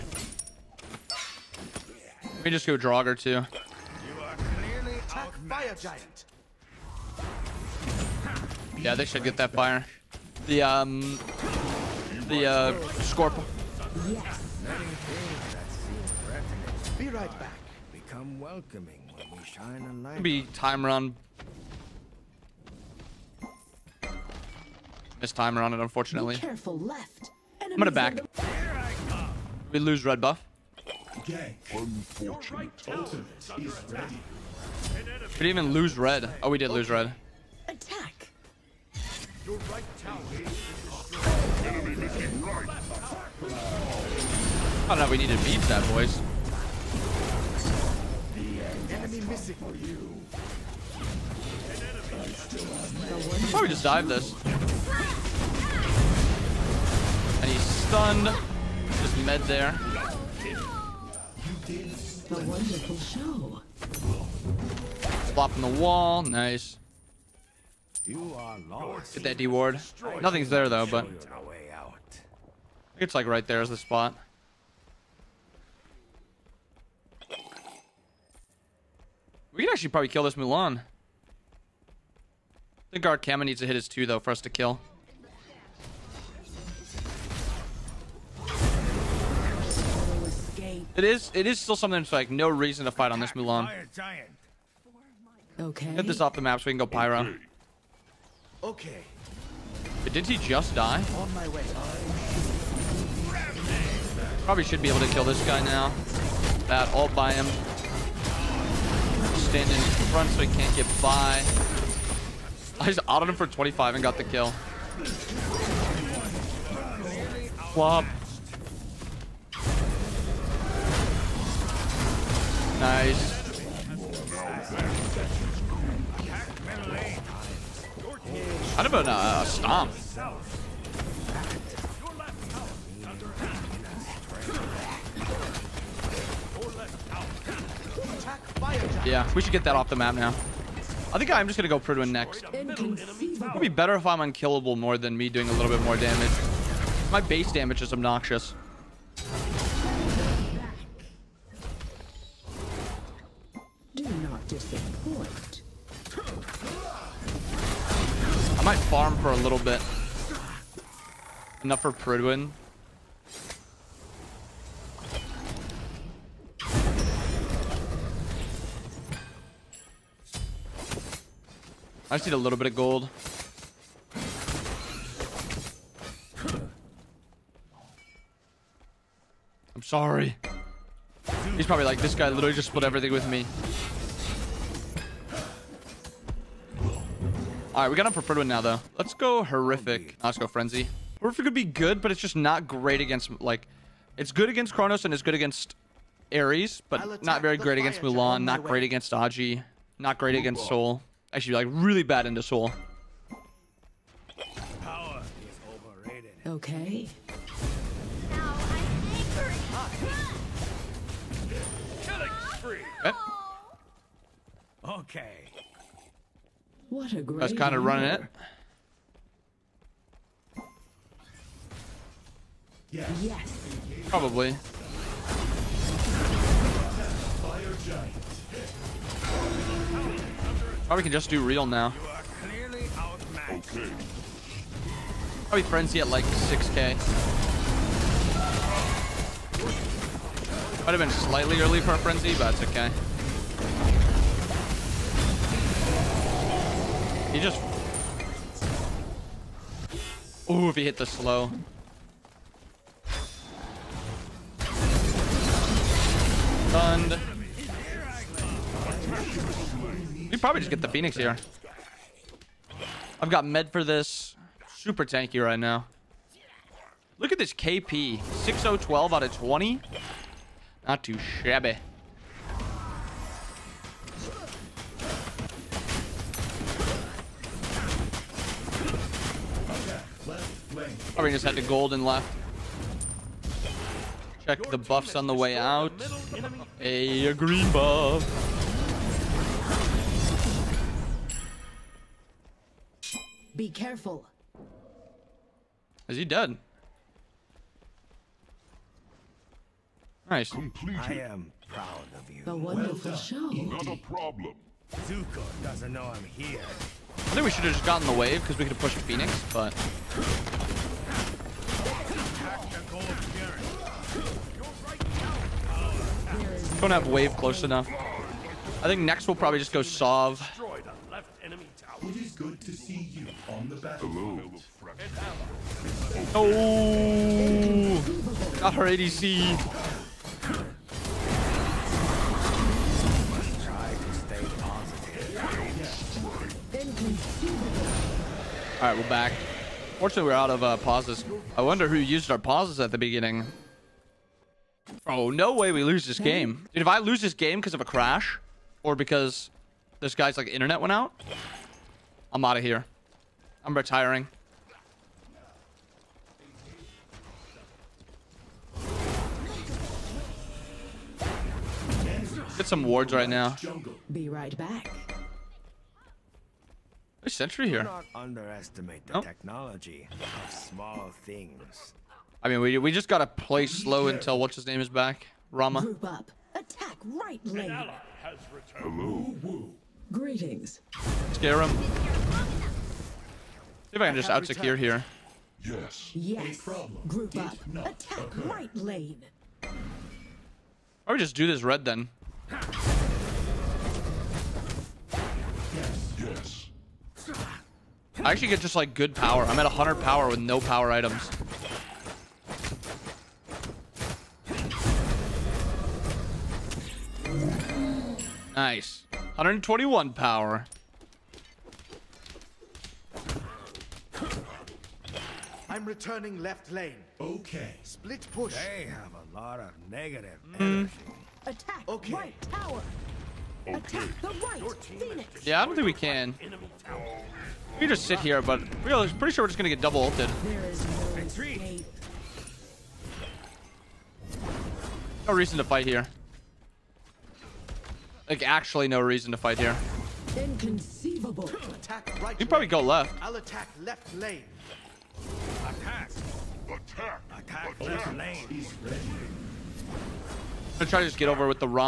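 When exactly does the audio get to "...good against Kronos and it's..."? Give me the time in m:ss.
3:14.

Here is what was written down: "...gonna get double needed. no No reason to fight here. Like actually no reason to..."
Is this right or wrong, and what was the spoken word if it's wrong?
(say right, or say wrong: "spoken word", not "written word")
wrong: "ulted", not "needed".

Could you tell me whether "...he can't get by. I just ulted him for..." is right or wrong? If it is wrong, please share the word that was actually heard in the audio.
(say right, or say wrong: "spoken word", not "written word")
wrong: "autoed", not "ulted".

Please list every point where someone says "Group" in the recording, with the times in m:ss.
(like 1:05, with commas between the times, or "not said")
6:15, 6:27.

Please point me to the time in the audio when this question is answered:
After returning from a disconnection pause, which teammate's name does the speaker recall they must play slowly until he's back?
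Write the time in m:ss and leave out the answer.
6:15.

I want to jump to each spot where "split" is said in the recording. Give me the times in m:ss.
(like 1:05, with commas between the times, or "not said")
3:02, 6:57.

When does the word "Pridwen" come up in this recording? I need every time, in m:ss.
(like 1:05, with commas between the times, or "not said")
2:21, 2:41, 3:08.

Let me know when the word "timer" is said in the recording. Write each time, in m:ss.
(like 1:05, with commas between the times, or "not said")
0:20, 0:25.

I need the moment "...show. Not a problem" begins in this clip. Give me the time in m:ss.
5:03.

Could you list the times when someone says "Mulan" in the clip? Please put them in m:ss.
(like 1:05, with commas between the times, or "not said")
1:20, 1:33, 3:18.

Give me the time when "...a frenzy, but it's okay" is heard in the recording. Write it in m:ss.
4:01.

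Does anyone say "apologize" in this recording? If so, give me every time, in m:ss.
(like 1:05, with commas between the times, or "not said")
not said.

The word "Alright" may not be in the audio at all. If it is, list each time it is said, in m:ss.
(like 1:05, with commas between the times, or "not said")
3:07, 5:38.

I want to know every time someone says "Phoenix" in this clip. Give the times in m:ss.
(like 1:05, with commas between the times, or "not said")
4:20, 5:08, 7:04.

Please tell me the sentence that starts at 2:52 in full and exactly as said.
I just need a little bit of gold.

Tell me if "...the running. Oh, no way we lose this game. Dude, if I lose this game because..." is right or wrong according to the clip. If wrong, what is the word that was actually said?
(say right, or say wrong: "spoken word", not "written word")
wrong: "beginning", not "running".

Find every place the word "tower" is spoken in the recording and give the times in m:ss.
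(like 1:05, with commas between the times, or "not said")
0:40, 7:02.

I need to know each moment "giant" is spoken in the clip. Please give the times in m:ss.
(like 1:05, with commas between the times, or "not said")
0:05, 3:47.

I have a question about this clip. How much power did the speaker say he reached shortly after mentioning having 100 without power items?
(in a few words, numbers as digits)
121.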